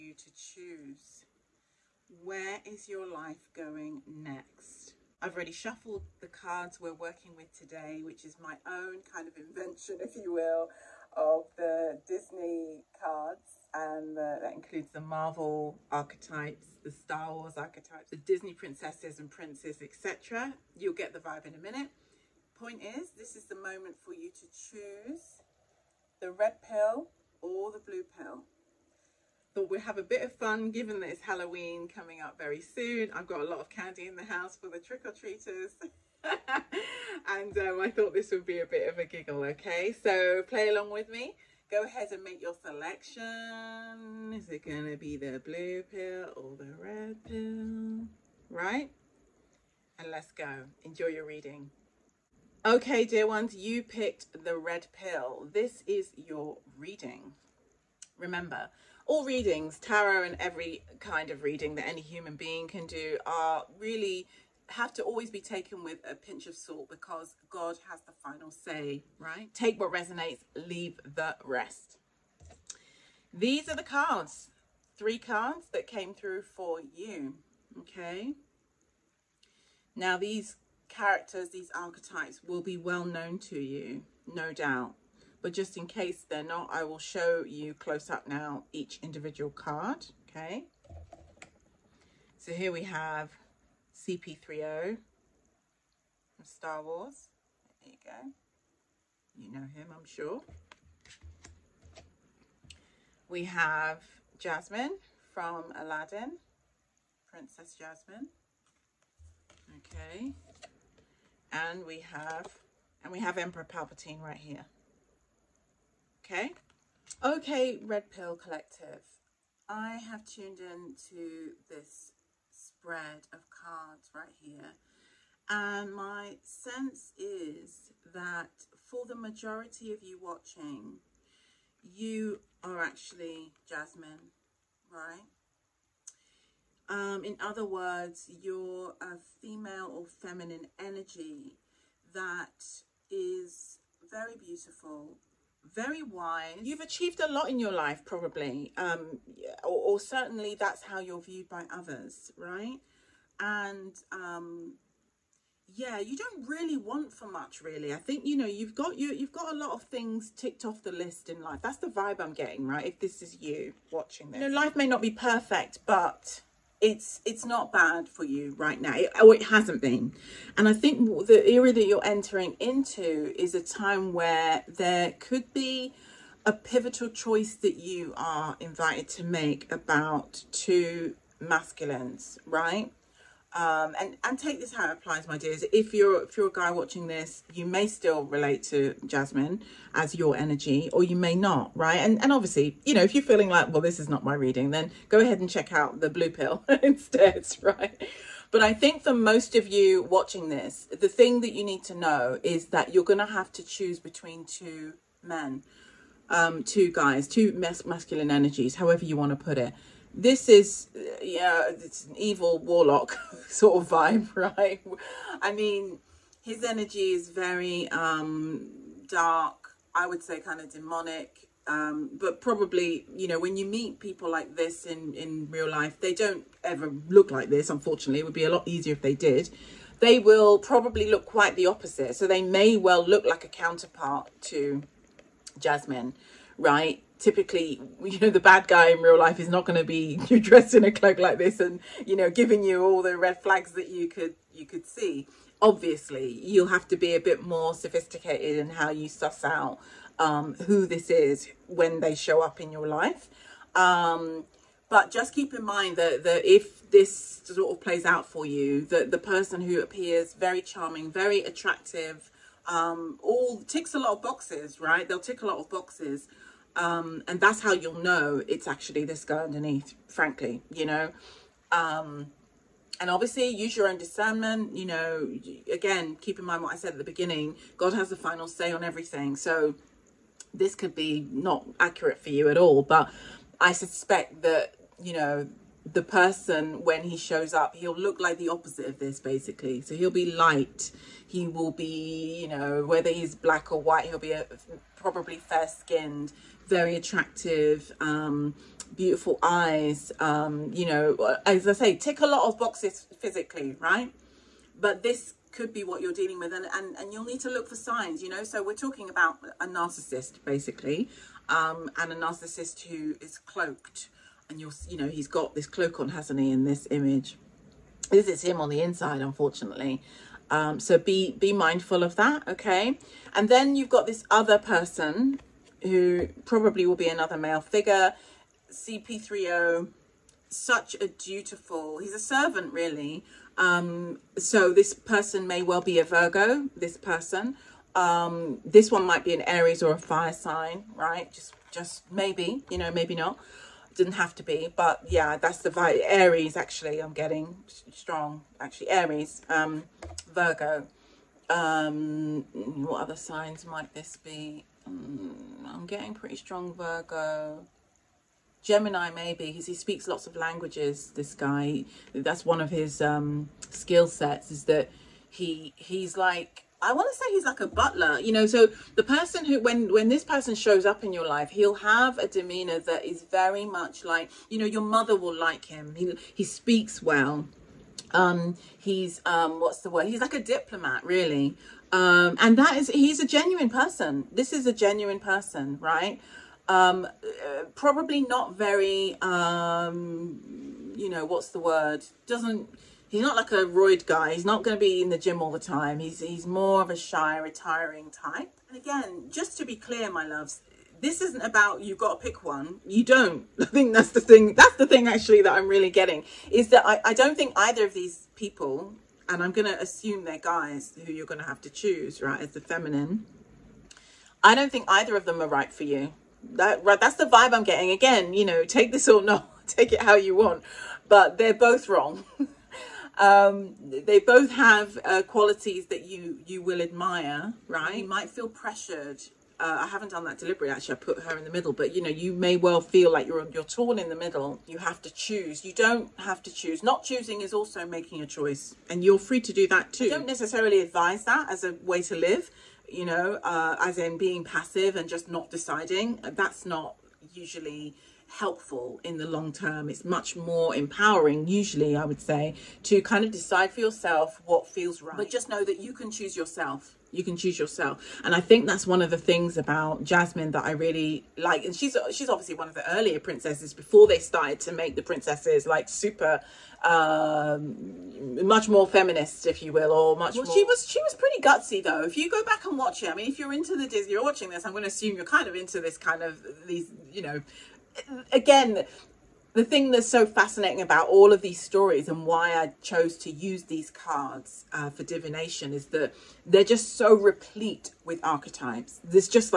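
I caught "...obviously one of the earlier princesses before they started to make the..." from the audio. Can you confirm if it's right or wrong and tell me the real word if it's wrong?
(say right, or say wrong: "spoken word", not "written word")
right.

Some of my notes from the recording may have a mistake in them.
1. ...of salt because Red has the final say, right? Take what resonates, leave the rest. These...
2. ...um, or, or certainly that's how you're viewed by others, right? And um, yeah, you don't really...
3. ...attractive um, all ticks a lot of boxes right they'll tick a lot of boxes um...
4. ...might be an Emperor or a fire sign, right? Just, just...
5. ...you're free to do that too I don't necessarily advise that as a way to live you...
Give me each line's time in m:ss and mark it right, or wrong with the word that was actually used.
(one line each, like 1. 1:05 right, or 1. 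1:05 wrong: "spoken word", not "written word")
1. 1:06 wrong: "God", not "Red"
2. 2:28 right
3. 4:21 right
4. 5:39 wrong: "Aries", not "Emperor"
5. 7:19 right.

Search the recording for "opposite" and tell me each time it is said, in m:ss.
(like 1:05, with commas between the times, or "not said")
3:51, 4:48.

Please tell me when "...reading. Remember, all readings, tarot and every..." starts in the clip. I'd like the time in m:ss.
0:56.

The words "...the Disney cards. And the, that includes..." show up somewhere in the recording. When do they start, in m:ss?
0:11.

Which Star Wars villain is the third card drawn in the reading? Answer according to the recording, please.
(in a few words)
Emperor Palpatine.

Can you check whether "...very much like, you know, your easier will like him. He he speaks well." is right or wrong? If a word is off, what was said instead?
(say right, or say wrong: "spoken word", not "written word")
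wrong: "mother", not "easier".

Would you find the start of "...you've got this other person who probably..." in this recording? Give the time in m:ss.
5:23.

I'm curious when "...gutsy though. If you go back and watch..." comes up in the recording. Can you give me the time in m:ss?
7:51.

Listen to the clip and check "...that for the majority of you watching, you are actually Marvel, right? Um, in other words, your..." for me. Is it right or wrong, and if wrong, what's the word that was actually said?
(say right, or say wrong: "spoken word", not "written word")
wrong: "Jasmine", not "Marvel".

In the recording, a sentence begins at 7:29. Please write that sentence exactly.
It's much more empowering, usually, I would say, to kind of decide for yourself what feels right.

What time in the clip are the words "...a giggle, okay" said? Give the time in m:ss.
0:38.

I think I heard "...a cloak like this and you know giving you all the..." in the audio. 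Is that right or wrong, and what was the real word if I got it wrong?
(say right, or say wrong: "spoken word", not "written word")
right.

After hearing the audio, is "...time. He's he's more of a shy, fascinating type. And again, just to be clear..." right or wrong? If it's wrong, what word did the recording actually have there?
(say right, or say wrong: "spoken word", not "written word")
wrong: "retiring", not "fascinating".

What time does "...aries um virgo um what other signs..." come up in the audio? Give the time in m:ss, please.
5:48.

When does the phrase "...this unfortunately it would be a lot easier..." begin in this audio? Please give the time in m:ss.
3:47.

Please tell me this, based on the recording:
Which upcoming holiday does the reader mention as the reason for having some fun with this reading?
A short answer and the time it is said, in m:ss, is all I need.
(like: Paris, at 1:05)
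Halloween, at 0:31.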